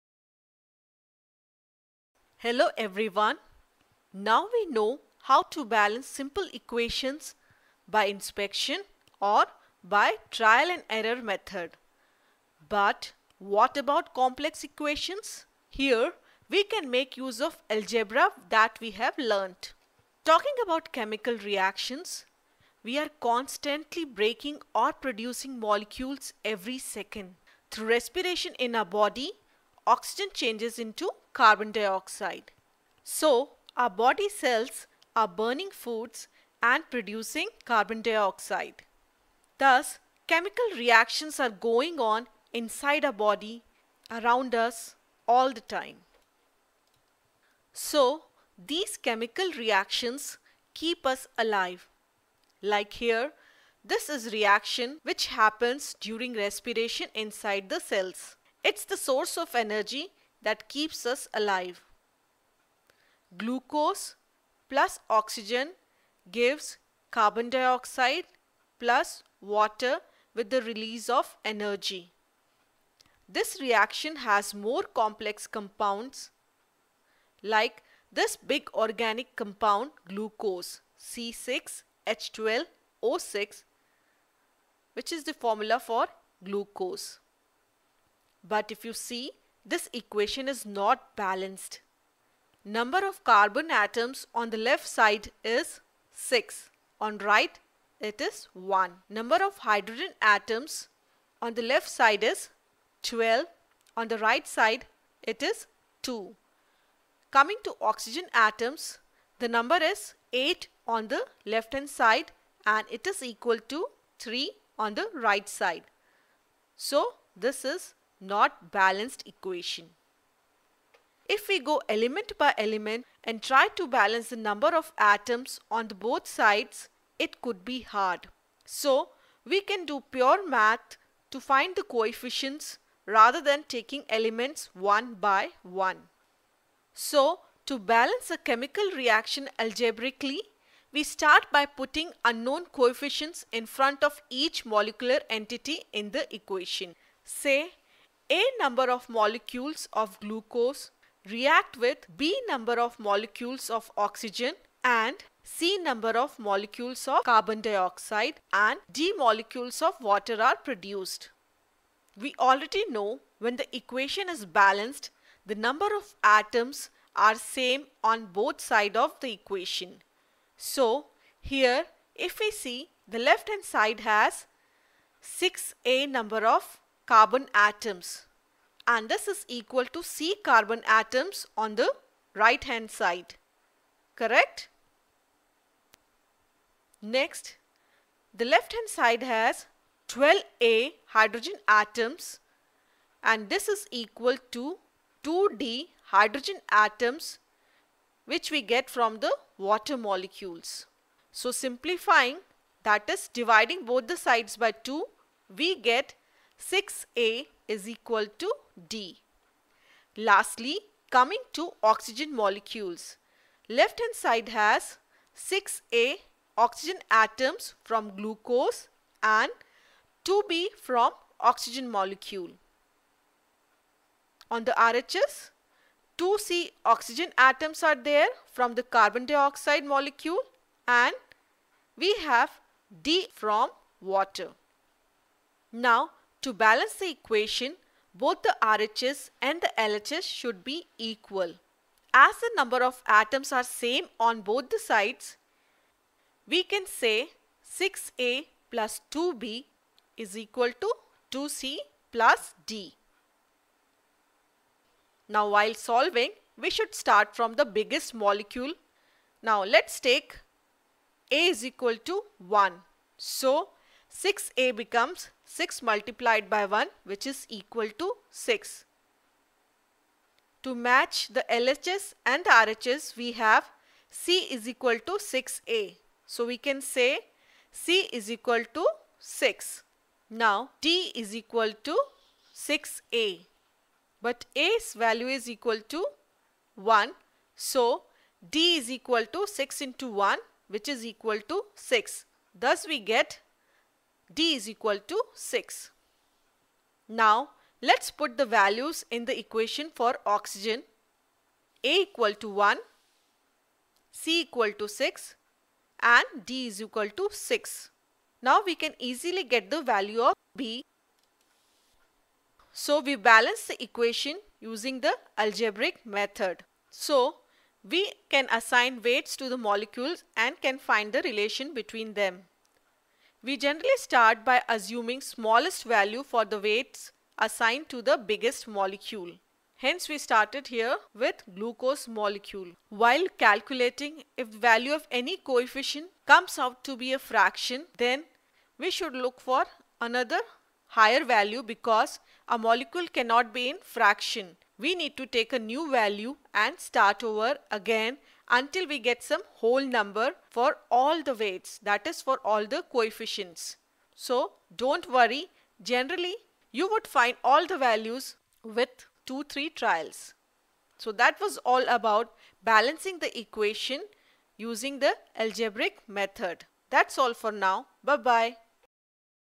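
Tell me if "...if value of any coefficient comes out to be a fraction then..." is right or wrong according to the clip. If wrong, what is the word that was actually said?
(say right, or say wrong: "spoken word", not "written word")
right.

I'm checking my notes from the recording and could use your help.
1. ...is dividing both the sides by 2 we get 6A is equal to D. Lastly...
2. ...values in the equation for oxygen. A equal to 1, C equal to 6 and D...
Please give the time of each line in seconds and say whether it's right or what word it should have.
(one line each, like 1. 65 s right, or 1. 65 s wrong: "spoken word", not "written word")
1. 203 s right
2. 298 s right.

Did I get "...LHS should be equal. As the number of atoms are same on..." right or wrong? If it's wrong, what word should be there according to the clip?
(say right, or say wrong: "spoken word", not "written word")
right.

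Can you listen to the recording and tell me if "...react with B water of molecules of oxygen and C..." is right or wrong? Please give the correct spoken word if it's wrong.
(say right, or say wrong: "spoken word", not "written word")
wrong: "number", not "water".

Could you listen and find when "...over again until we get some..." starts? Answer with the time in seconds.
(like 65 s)
347 s.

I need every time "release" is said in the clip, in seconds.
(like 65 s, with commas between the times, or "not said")
70 s.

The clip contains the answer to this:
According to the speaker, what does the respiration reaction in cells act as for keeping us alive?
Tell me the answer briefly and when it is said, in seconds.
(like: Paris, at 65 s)
Source of energy, at 58 s.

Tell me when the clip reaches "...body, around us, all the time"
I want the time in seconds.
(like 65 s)
43 s.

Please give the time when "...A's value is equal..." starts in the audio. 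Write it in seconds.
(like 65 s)
284 s.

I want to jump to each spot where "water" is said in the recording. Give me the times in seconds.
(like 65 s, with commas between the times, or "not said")
69 s, 159 s, 199 s, 234 s.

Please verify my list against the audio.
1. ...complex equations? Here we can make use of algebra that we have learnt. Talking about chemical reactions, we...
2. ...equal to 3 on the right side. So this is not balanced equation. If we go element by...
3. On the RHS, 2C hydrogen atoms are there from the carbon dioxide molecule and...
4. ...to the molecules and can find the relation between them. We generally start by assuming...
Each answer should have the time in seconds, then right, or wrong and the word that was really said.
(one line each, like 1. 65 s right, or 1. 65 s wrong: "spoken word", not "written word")
1. 14 s right
2. 113 s right
3. 224 s wrong: "oxygen", not "hydrogen"
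4. 319 s right.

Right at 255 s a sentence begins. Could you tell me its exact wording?
Now while solving, we should start from the biggest molecule.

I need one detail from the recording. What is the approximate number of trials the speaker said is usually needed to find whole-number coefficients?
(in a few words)
2-3.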